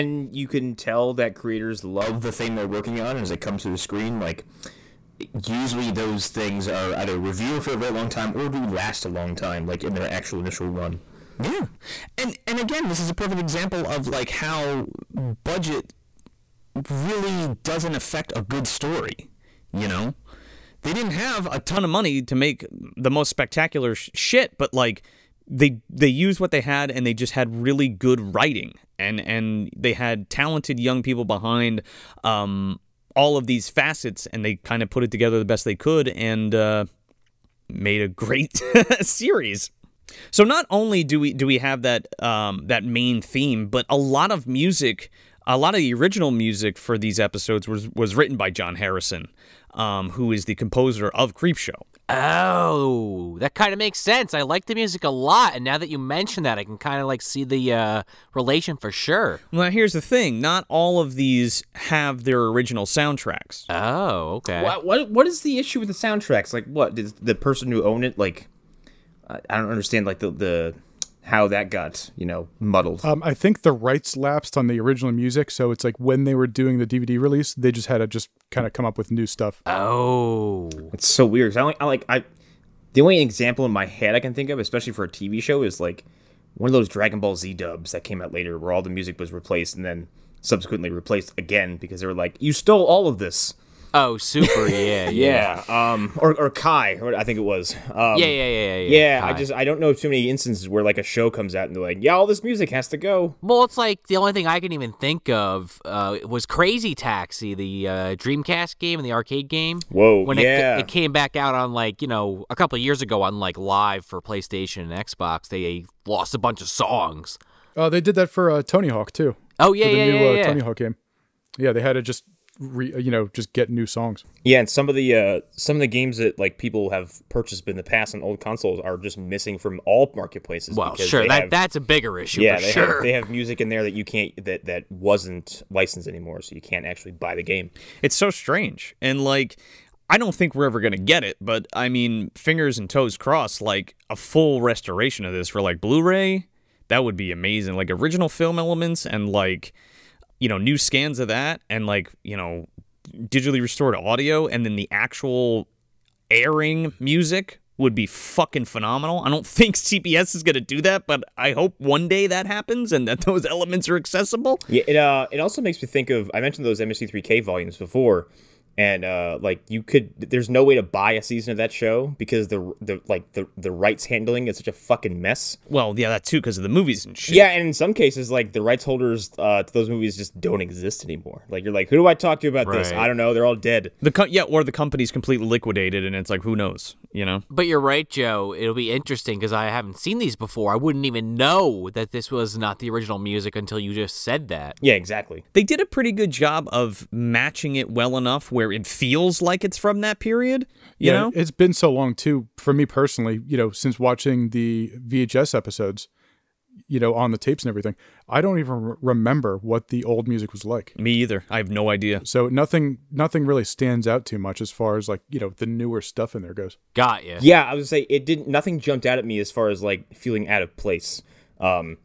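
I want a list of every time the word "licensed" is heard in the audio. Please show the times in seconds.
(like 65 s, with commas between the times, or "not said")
135 s.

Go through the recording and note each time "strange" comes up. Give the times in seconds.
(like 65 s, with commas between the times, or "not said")
138 s.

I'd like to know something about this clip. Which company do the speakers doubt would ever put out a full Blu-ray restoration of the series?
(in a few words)
CBS.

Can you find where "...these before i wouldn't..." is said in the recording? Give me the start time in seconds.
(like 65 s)
190 s.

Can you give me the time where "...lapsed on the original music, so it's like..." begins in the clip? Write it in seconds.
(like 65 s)
74 s.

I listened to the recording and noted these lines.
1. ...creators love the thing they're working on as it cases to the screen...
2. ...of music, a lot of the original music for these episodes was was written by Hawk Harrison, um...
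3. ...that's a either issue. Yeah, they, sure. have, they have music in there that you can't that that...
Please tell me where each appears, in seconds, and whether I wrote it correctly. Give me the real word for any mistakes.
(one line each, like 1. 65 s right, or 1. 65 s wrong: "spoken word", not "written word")
1. 1 s wrong: "comes", not "cases"
2. 44 s wrong: "John", not "Hawk"
3. 131 s wrong: "bigger", not "either".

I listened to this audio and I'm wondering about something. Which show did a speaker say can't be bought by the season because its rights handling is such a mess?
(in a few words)
MST3K.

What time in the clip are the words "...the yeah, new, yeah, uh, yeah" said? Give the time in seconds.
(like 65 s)
119 s.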